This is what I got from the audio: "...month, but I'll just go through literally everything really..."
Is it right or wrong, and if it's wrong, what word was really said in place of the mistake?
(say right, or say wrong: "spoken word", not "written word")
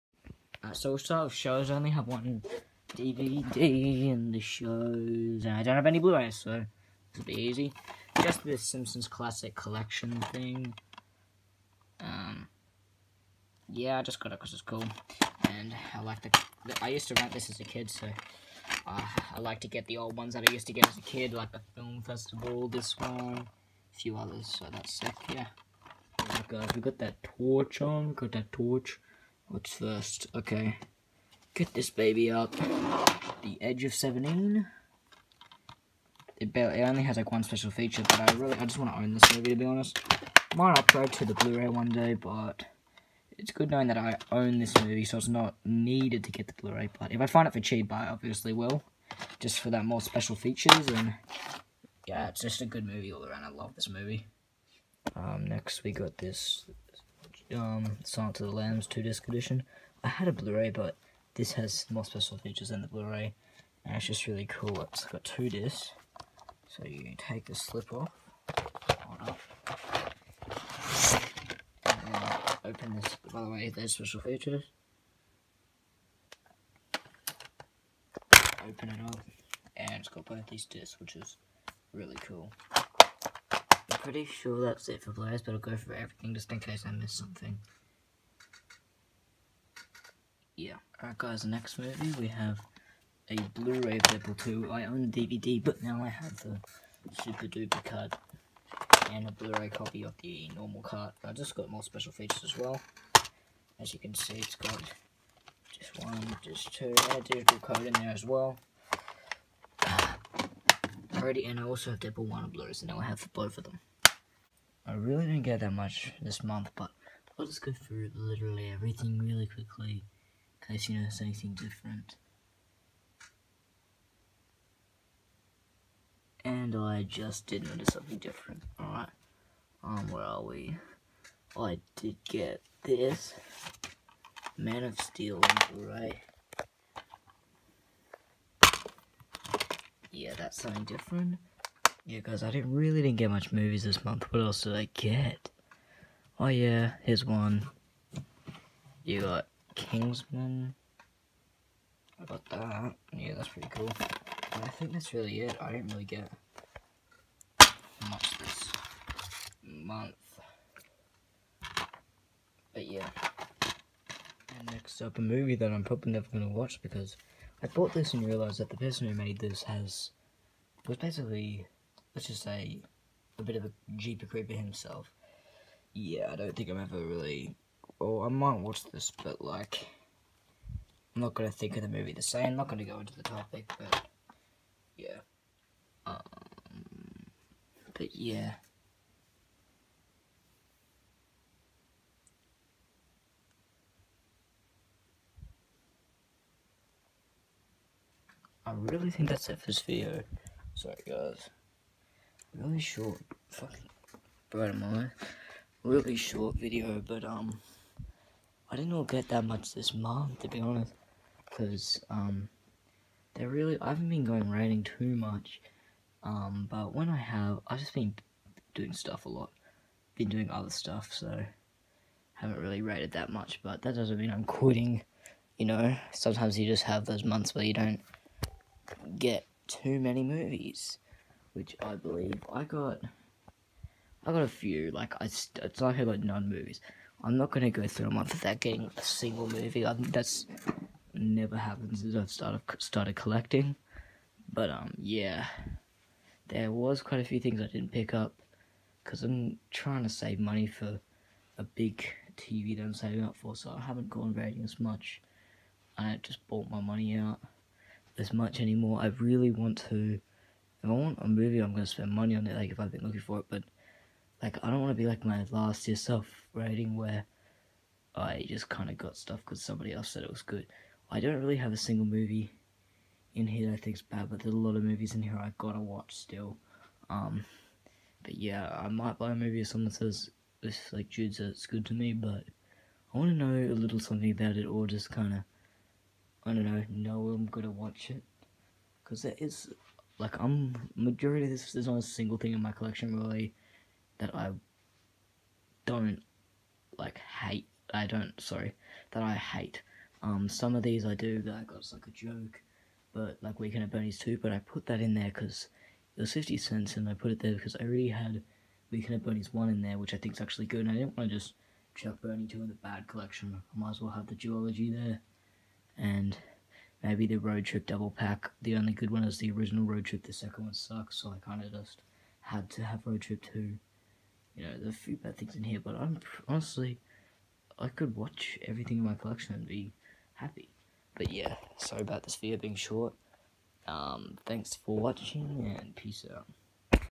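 right.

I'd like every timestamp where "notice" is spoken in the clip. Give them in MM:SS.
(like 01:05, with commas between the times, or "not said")
02:00, 02:07.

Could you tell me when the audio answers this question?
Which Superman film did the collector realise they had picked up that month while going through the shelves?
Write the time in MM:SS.
02:14.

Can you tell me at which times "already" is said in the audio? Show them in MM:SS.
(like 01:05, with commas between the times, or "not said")
01:51, 05:07.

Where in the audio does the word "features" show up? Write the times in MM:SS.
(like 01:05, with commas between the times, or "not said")
00:37, 00:50, 01:02, 01:14, 01:42.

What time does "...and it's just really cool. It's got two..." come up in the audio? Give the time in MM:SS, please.
01:03.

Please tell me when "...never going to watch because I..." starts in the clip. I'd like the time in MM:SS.
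02:46.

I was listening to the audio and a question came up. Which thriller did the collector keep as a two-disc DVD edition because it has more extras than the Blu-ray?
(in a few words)
Silence of the Lambs.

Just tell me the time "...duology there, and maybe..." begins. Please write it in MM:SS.
05:14.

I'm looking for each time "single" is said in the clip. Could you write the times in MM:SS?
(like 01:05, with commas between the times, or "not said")
03:59, 04:31, 04:52.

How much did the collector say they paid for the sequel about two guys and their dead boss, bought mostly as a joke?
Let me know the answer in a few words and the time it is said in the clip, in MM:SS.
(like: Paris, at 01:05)
50 cents, at 05:06.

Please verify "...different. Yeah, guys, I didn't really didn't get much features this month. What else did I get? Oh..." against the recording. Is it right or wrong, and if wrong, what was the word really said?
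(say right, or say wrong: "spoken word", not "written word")
wrong: "movies", not "features".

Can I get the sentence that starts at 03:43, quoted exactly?
But that doesn't mean I'm quitting.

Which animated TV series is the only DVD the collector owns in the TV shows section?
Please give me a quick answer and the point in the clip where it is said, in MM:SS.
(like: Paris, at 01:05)
The Simpsons, at 00:08.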